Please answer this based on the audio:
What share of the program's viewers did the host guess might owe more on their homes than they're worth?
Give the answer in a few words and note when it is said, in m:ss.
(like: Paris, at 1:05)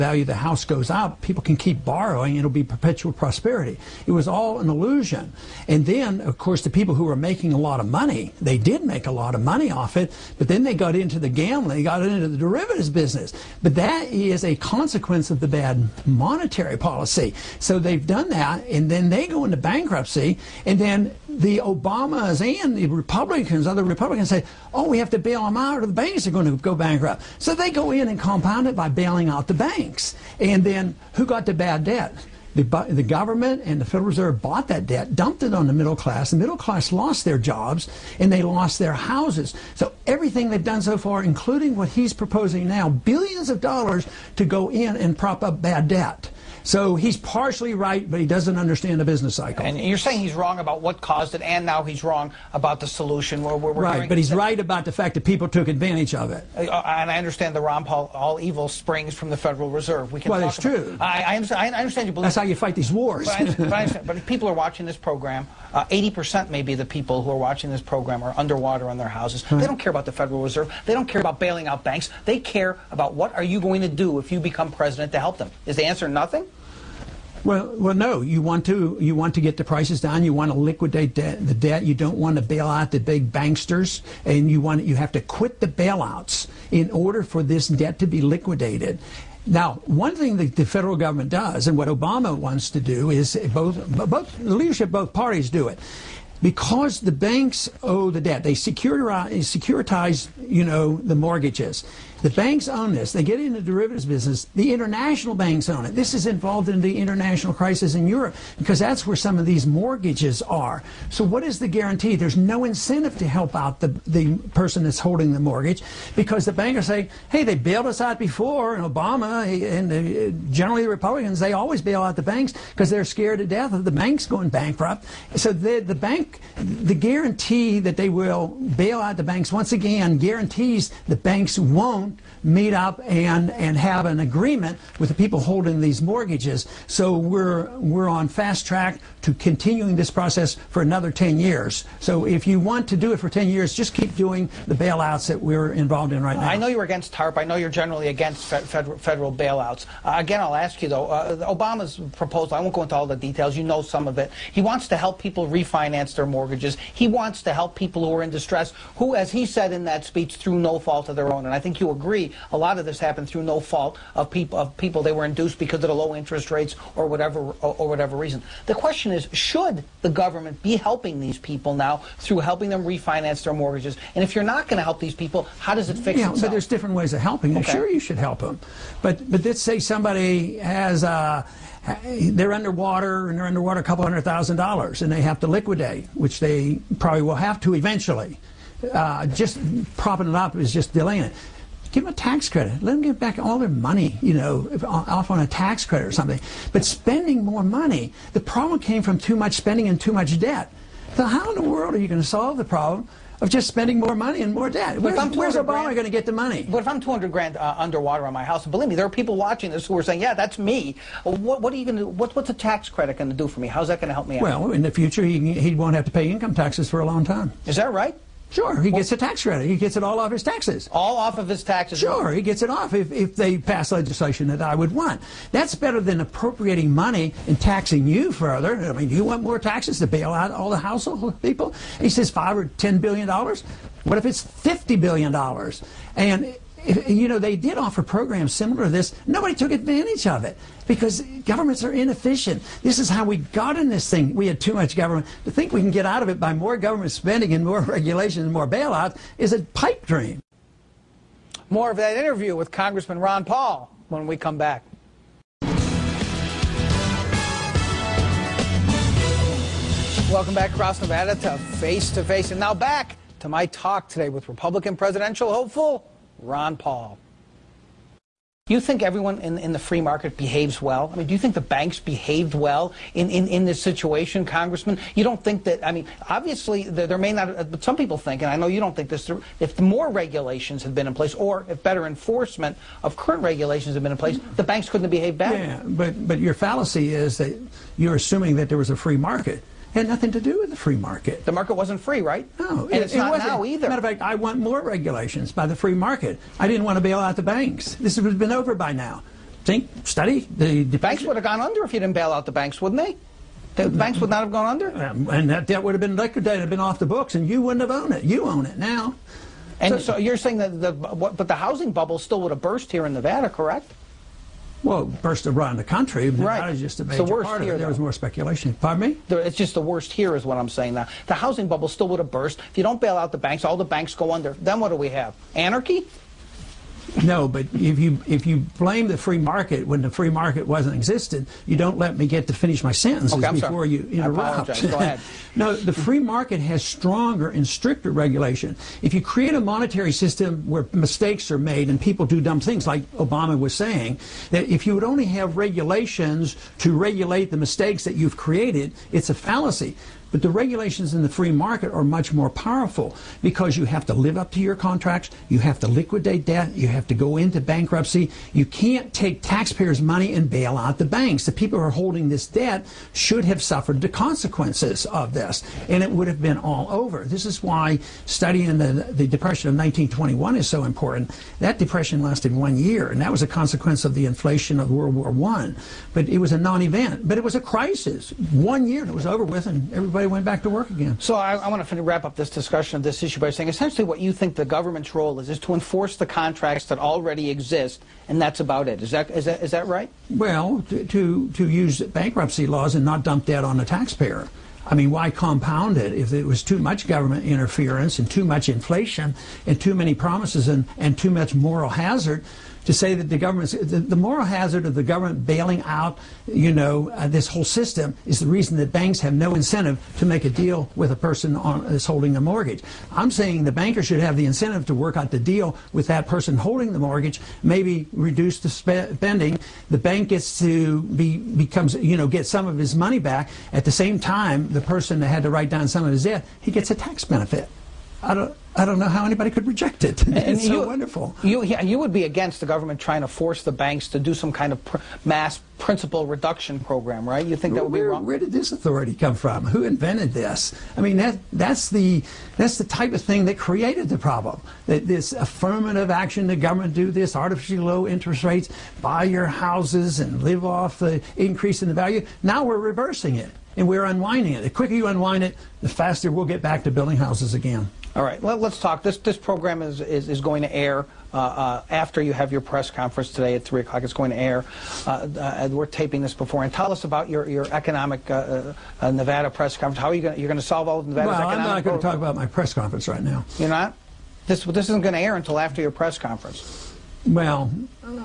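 80%, at 1:05.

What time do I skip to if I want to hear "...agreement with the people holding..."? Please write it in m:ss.
2:14.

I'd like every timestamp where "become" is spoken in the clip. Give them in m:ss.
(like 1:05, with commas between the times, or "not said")
1:14, 7:01.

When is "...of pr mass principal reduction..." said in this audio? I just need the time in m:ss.
7:14.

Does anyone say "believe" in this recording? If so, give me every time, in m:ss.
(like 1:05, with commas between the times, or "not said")
1:02, 3:28.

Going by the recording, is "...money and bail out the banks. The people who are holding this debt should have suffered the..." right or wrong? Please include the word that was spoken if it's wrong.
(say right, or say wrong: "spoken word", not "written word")
right.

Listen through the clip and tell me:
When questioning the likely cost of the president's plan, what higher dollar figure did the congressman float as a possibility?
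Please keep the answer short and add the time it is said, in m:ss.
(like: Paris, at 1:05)
50 billion dollars, at 3:54.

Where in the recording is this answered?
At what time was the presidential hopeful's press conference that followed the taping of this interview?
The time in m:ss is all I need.
7:43.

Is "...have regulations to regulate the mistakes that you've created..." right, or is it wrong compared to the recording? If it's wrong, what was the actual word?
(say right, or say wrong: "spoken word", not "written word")
right.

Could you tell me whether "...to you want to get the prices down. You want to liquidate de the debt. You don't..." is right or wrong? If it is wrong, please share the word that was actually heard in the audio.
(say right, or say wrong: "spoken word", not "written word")
right.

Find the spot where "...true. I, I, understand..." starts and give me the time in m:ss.
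1:00.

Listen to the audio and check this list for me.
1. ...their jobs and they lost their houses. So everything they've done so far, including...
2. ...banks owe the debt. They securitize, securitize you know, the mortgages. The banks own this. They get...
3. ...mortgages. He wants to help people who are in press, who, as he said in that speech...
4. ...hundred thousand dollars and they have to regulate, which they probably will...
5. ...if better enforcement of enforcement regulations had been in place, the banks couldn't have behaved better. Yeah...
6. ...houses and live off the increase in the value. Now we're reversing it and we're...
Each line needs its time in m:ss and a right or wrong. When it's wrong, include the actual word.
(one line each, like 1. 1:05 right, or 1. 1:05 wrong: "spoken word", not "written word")
1. 0:37 right
2. 1:37 right
3. 2:36 wrong: "distress", not "press"
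4. 3:04 wrong: "liquidate", not "regulate"
5. 4:41 wrong: "current", not "enforcement"
6. 7:29 right.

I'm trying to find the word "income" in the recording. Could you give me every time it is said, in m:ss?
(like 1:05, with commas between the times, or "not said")
3:36.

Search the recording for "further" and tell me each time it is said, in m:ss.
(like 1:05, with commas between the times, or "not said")
3:48.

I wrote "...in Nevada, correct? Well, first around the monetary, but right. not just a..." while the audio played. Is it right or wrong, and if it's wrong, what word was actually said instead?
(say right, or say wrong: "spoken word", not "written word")
wrong: "country", not "monetary".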